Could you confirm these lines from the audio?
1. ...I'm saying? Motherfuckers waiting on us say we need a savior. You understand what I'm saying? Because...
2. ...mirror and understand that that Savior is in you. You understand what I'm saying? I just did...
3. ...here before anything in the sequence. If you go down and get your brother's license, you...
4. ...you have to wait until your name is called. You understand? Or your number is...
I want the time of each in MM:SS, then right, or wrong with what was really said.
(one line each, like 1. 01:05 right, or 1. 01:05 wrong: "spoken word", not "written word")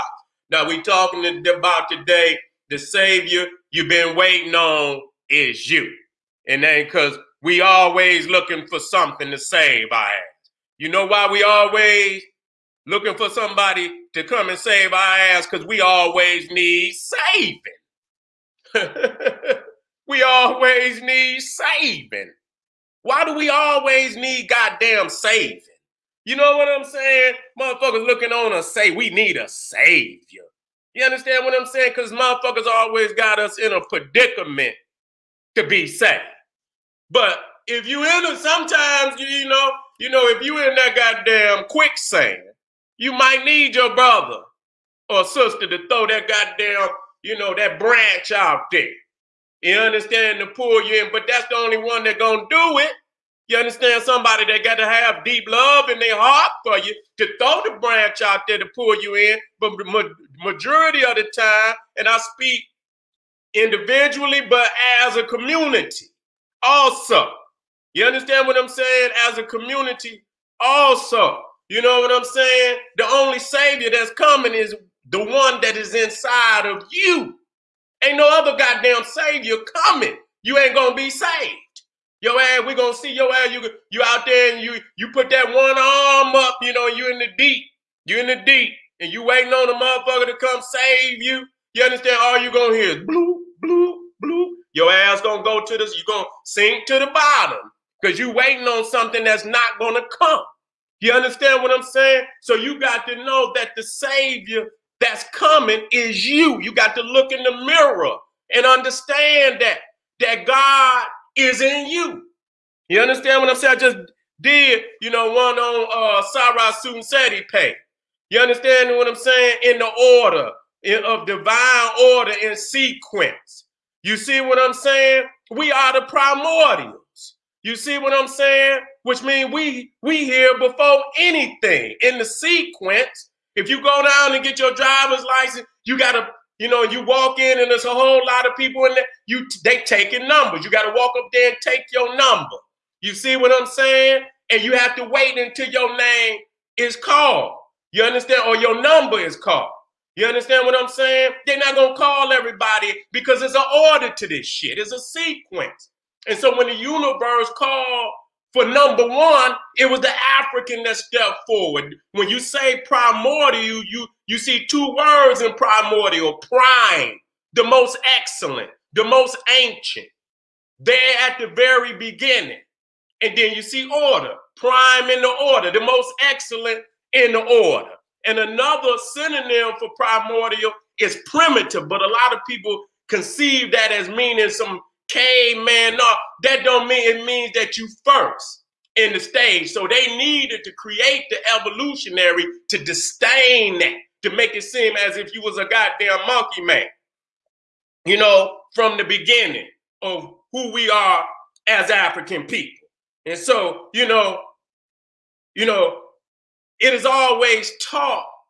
1. 00:26 wrong: "looking", not "waiting"
2. 01:47 wrong: "God", not "Savior"
3. 02:10 wrong: "driver", not "brother"
4. 02:24 right.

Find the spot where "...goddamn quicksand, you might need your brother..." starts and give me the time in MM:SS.
00:40.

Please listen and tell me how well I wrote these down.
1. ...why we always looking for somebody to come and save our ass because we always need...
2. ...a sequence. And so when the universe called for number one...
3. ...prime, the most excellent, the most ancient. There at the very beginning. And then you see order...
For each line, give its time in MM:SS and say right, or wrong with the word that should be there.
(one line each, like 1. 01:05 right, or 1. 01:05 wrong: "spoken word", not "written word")
1. 00:11 right
2. 02:34 right
3. 02:46 right.